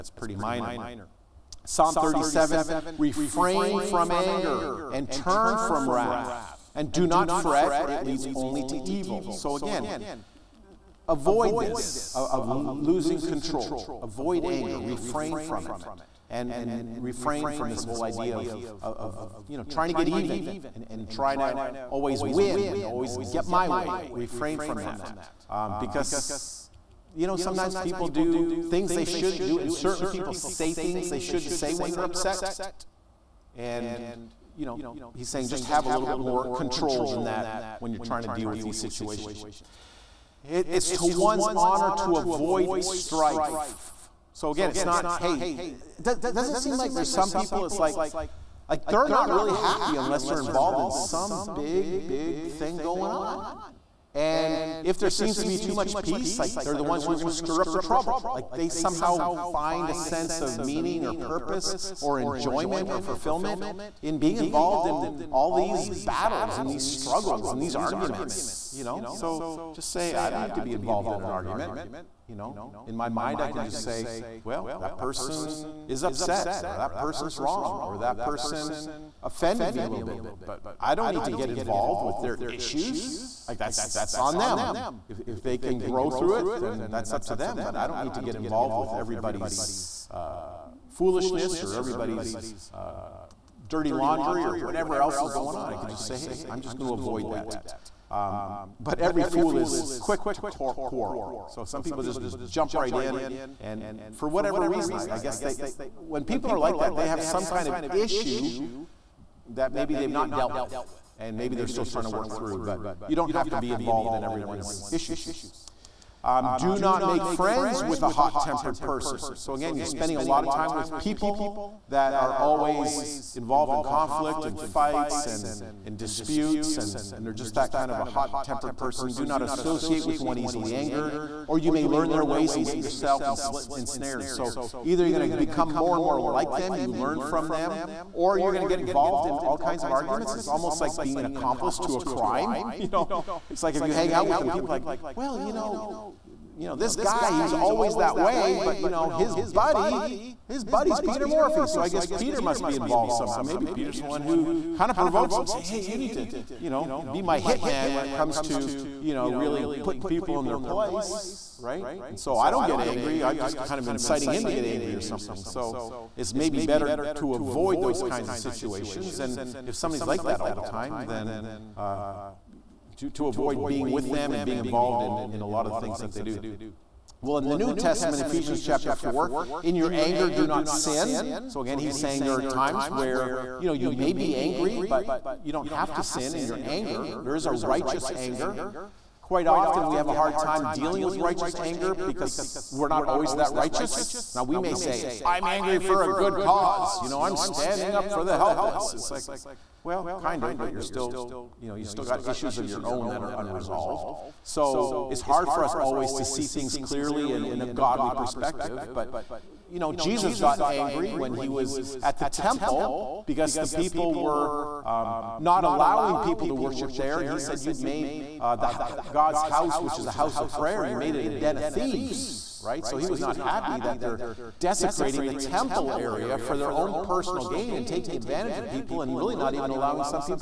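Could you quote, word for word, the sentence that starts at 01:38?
Um, but every fool is quick to quarrel.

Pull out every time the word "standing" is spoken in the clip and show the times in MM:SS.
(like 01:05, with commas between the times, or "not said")
03:17.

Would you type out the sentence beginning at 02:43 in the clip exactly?
I'm just kind of inciting him to get angry or something.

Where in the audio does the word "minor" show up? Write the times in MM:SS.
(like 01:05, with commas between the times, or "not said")
00:00.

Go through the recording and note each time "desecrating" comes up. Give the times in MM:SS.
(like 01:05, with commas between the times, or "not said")
03:44.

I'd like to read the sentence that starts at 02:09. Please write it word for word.
Do not associate with one easily angered, or you may learn their ways and get yourself ensnared.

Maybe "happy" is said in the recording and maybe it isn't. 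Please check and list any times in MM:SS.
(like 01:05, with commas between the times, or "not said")
00:49, 03:43.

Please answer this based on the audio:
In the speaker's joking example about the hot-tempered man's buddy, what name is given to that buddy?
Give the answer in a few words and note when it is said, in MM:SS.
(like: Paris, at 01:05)
Peter Morphy, at 02:31.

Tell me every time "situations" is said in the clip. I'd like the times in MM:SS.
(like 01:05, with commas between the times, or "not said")
00:38, 02:48.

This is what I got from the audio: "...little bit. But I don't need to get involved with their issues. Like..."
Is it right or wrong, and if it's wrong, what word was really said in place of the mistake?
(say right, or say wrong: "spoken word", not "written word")
right.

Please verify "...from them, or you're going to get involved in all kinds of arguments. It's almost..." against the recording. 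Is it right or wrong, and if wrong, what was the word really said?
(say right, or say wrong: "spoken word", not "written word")
right.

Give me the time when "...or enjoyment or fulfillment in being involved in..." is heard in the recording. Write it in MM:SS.
01:01.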